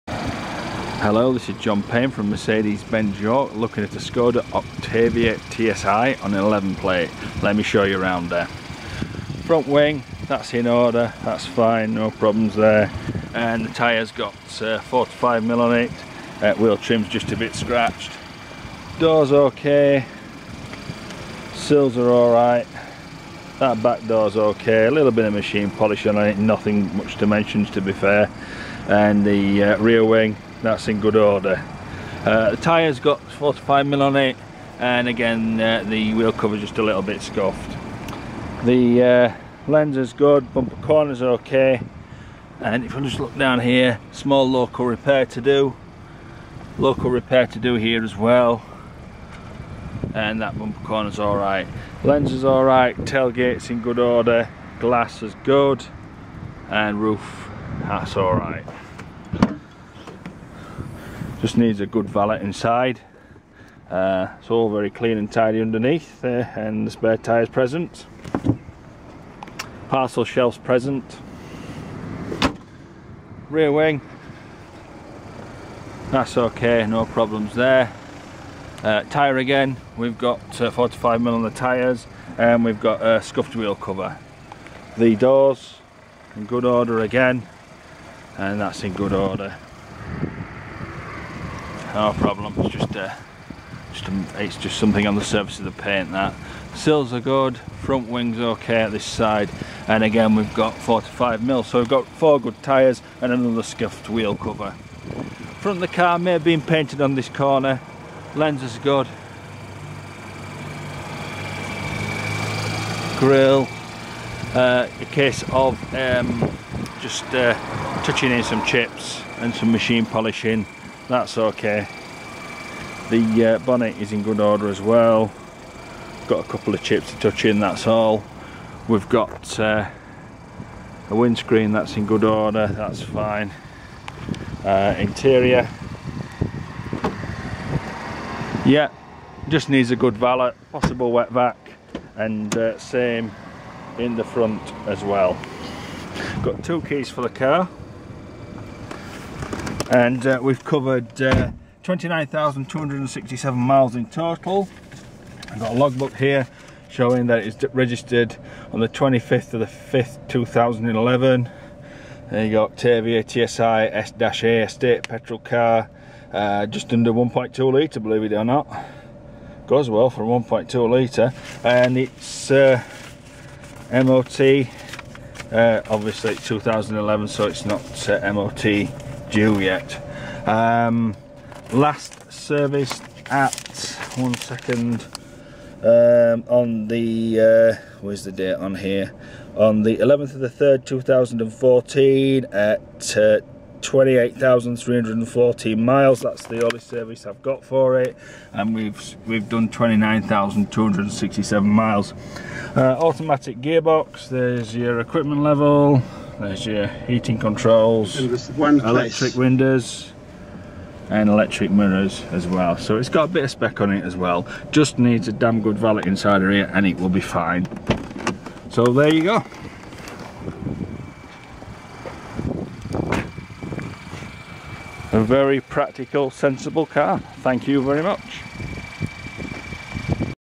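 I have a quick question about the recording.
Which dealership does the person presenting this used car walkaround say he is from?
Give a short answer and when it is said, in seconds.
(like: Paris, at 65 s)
Mercedes-Benz York, at 2 s.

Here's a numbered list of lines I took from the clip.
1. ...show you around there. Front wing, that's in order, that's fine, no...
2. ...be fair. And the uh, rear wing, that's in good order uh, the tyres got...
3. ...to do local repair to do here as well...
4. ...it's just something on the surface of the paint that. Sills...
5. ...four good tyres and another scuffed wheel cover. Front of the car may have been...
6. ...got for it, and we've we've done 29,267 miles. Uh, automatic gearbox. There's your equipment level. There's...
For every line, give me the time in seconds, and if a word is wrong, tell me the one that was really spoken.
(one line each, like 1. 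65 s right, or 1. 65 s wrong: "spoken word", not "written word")
1. 7 s right
2. 27 s right
3. 45 s right
4. 94 s right
5. 102 s right
6. 197 s right.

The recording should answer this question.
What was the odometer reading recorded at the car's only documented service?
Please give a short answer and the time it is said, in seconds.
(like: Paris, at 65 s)
28,314 miles, at 193 s.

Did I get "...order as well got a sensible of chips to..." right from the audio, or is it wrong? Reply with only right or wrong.
wrong.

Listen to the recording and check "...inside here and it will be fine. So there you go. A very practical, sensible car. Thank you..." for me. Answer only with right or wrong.
right.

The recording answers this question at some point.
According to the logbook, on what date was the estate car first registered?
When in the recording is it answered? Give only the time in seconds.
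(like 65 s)
158 s.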